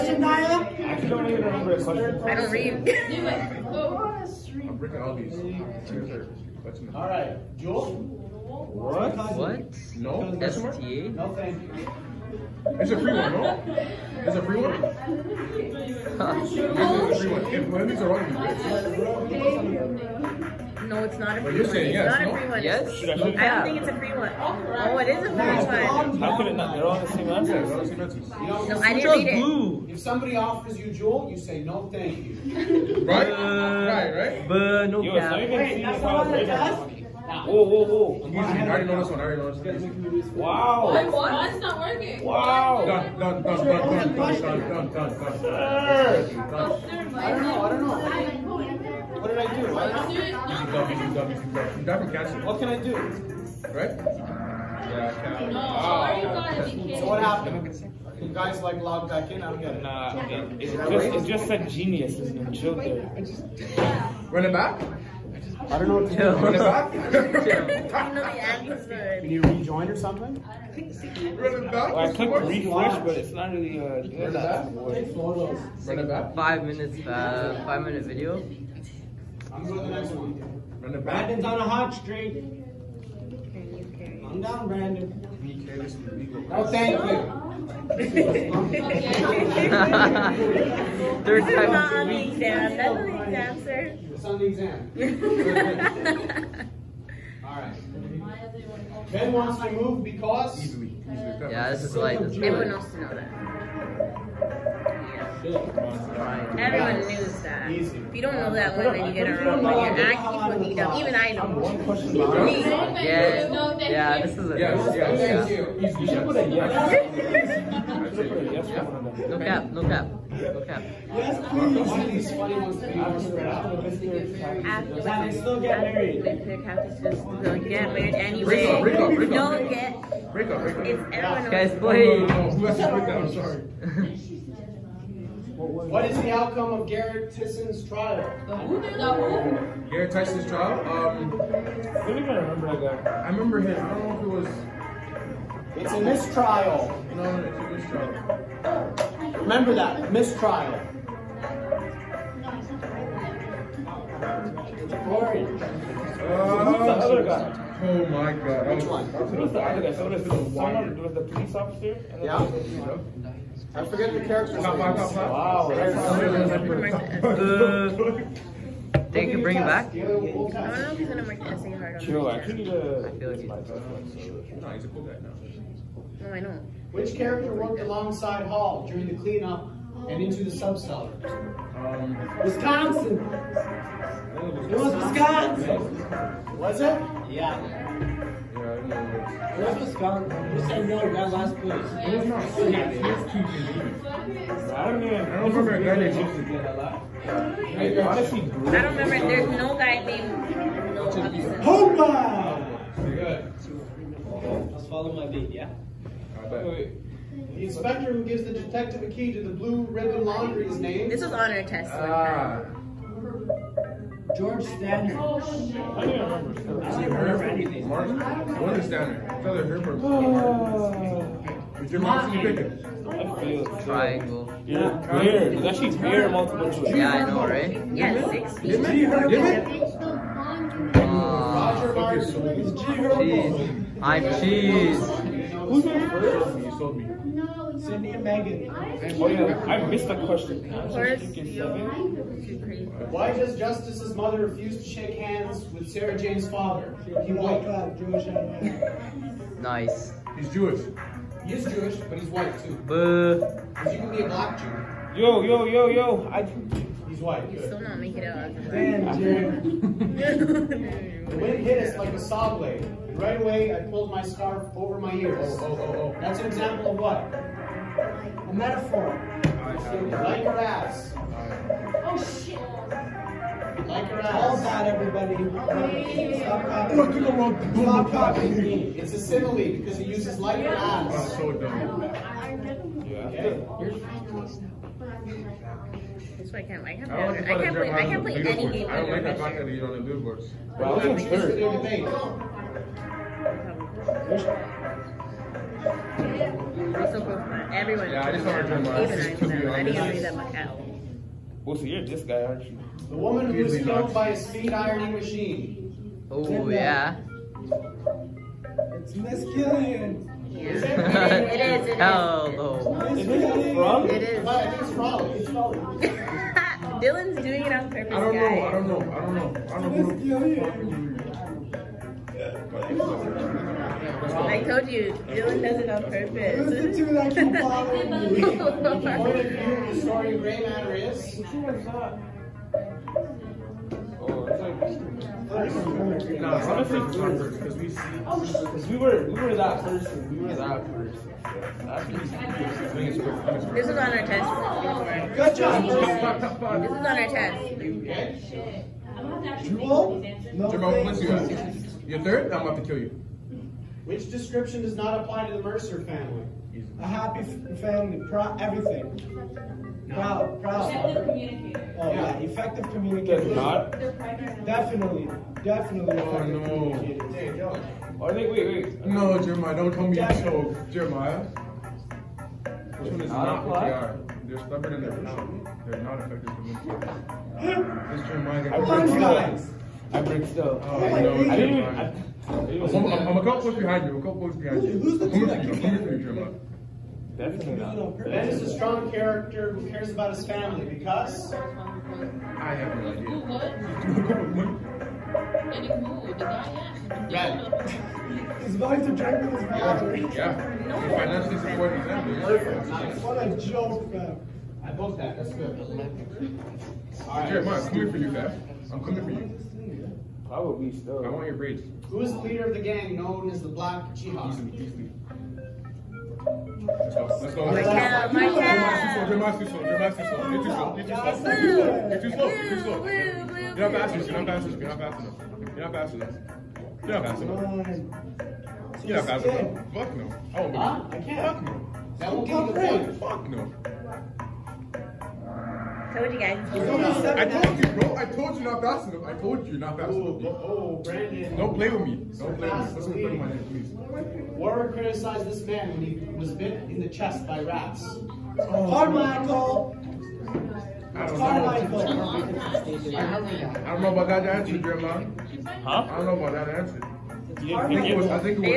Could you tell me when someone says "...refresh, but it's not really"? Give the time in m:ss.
1:12.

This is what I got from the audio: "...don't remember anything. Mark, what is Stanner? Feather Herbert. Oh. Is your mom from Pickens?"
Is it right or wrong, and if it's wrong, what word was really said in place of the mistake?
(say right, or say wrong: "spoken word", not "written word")
right.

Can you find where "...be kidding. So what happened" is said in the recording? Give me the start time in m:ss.
0:56.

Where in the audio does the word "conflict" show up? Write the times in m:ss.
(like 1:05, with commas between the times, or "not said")
not said.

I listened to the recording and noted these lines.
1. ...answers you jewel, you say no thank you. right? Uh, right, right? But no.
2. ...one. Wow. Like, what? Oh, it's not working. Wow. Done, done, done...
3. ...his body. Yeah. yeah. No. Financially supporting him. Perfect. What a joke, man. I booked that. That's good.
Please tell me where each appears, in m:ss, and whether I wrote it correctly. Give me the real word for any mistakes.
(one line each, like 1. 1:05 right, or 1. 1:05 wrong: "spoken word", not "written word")
1. 0:30 wrong: "offers", not "answers"
2. 0:40 right
3. 6:39 right.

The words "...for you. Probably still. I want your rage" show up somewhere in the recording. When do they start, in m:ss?
6:49.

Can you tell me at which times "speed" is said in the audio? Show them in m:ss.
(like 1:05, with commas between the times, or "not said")
5:04.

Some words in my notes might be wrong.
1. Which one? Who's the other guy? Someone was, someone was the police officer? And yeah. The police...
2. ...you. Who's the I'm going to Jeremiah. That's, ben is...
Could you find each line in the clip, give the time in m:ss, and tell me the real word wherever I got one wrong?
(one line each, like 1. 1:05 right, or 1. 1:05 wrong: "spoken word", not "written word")
1. 2:38 right
2. 6:24 right.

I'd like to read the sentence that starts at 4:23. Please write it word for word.
right away, I pulled my scarf over my ears.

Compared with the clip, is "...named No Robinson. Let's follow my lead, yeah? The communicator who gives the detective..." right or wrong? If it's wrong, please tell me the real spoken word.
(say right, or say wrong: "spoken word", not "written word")
wrong: "inspector", not "communicator".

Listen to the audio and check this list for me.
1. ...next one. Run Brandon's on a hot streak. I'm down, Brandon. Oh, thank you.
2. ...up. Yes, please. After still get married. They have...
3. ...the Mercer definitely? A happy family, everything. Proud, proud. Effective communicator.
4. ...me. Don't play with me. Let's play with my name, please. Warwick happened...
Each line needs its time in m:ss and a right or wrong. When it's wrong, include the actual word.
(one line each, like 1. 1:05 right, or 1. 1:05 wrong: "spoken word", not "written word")
1. 1:19 right
2. 1:59 right
3. 5:55 wrong: "family", not "definitely"
4. 7:22 wrong: "criticized", not "happened".